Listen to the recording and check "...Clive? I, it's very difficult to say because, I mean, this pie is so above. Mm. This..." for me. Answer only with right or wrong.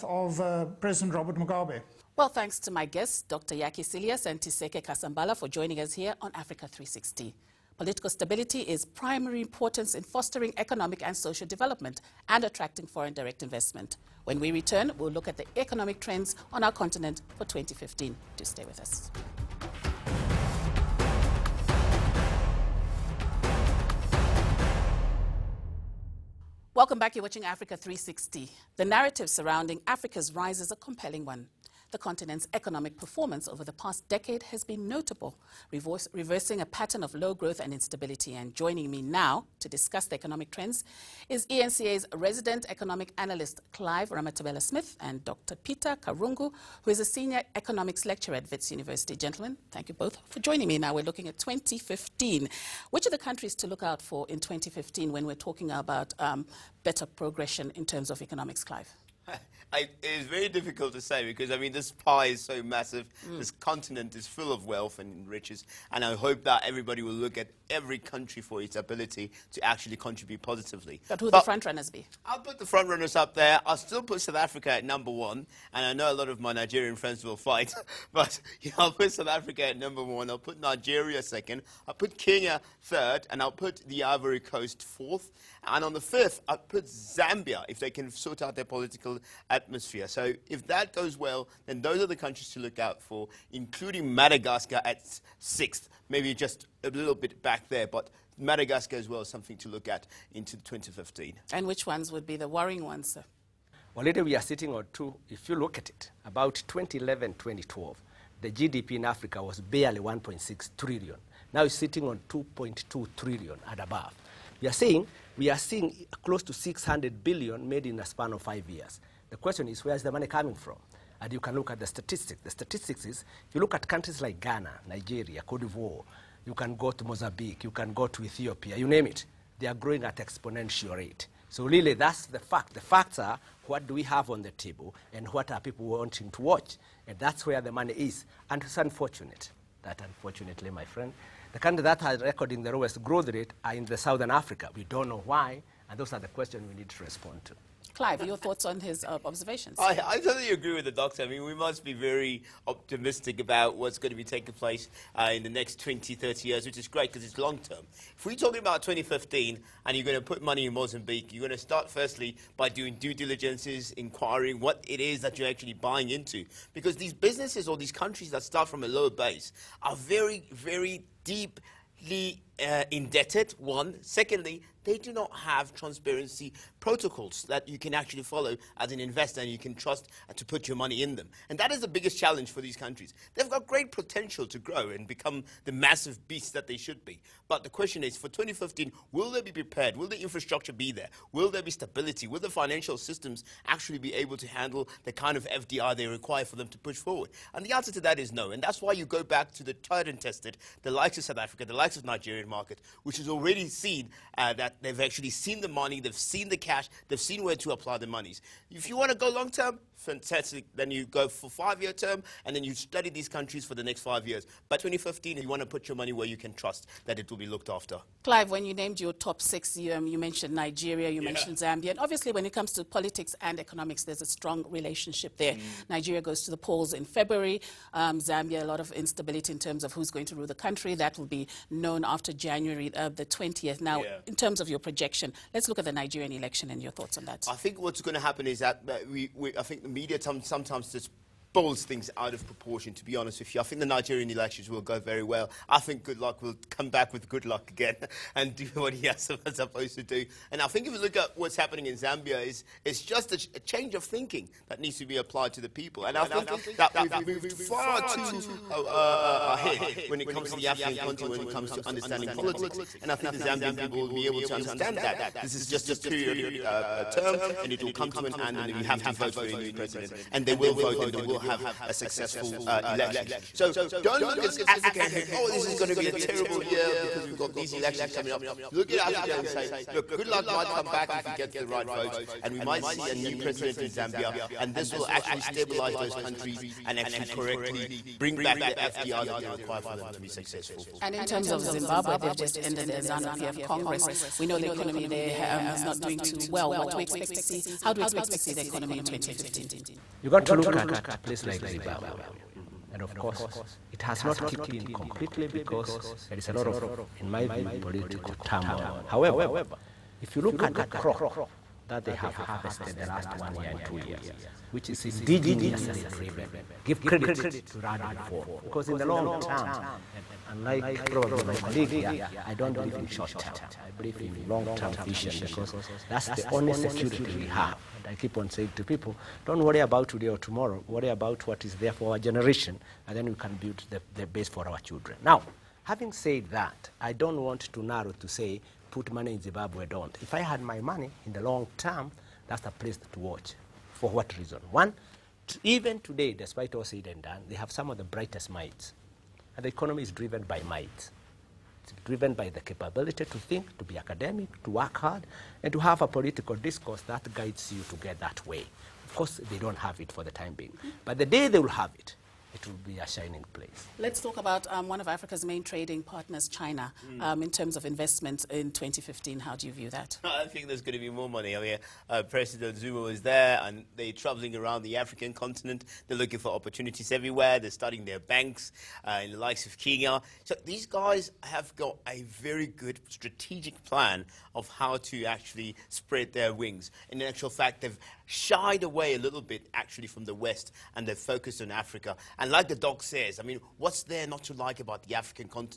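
wrong.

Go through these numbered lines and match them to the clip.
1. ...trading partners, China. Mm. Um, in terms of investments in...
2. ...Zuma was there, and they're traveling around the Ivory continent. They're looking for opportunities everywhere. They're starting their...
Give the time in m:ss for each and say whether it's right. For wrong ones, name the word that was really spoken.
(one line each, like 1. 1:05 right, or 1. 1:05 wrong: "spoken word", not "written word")
1. 6:05 right
2. 6:12 wrong: "African", not "Ivory".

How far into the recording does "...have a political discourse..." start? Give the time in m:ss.
5:55.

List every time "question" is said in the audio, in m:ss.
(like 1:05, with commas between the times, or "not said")
1:59, 2:26, 3:07.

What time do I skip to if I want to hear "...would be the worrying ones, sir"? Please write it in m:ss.
1:42.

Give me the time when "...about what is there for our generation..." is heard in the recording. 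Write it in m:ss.
5:31.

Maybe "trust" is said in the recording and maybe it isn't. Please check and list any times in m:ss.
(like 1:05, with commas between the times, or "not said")
2:59, 3:36.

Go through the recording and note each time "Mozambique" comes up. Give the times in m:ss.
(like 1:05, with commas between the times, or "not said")
2:07, 2:40.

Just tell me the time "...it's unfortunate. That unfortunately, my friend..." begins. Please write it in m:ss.
2:18.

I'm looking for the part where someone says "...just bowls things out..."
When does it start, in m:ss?
4:00.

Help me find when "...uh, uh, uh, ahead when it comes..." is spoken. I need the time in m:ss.
4:18.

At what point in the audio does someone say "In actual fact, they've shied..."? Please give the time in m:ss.
6:27.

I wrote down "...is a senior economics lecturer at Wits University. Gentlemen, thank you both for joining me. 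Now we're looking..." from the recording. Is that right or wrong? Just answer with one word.
right.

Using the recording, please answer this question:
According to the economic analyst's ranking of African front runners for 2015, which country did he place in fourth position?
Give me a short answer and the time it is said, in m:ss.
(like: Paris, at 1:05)
Ivory Coast, at 1:24.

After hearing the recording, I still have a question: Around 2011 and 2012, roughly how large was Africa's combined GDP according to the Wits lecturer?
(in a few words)
1.6 trillion.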